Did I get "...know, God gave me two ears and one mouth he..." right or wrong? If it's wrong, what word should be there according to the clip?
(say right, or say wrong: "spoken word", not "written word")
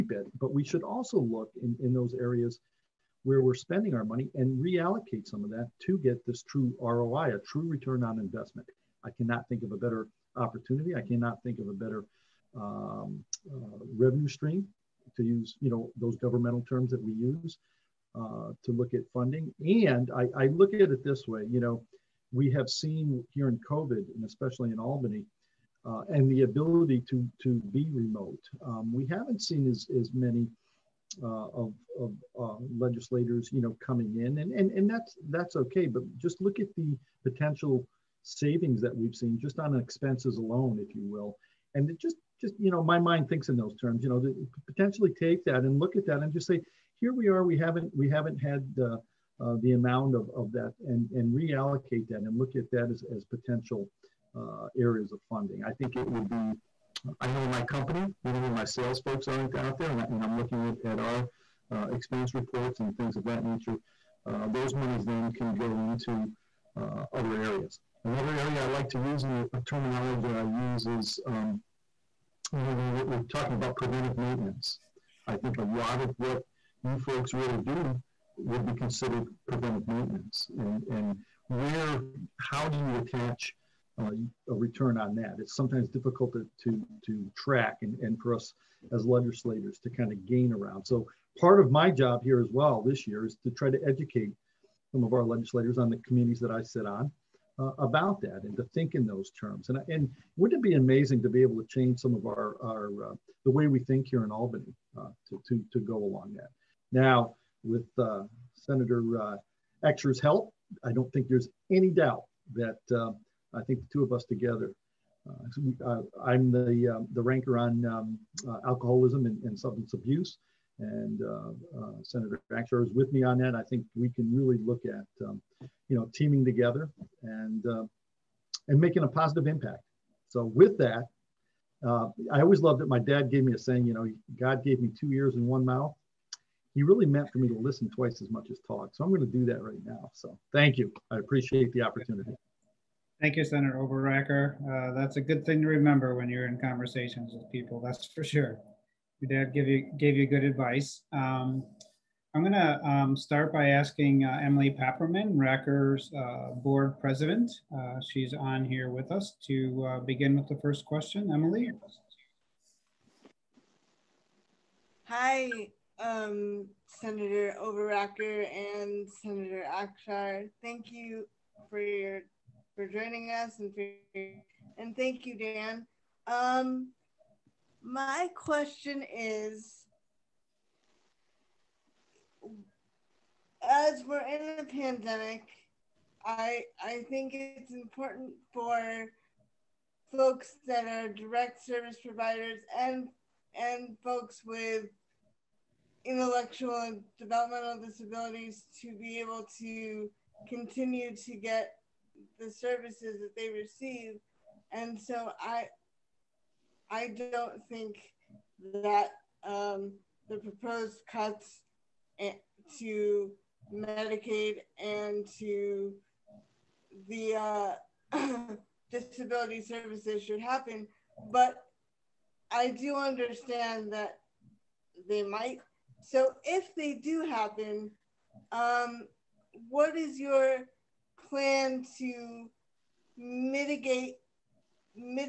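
right.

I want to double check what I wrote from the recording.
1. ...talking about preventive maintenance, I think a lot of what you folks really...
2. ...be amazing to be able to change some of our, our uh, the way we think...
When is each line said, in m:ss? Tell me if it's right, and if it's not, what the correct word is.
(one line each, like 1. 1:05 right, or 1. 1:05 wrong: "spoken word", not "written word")
1. 1:13 right
2. 1:40 right.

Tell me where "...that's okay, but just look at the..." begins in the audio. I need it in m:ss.
0:35.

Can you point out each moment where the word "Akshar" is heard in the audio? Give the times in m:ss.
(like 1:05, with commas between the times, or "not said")
1:49, 2:02, 2:49.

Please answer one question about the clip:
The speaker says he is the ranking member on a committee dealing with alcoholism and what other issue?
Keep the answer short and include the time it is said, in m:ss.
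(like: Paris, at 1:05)
substance abuse, at 1:59.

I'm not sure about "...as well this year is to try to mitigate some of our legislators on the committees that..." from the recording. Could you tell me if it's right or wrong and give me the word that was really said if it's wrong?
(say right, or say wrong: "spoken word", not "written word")
wrong: "educate", not "mitigate".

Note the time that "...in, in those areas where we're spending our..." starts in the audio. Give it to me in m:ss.
0:01.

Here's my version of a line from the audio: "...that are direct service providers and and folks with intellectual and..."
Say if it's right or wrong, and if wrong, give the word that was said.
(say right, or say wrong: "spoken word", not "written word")
right.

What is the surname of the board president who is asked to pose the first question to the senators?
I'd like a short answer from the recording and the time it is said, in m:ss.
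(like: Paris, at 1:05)
Papperman, at 2:34.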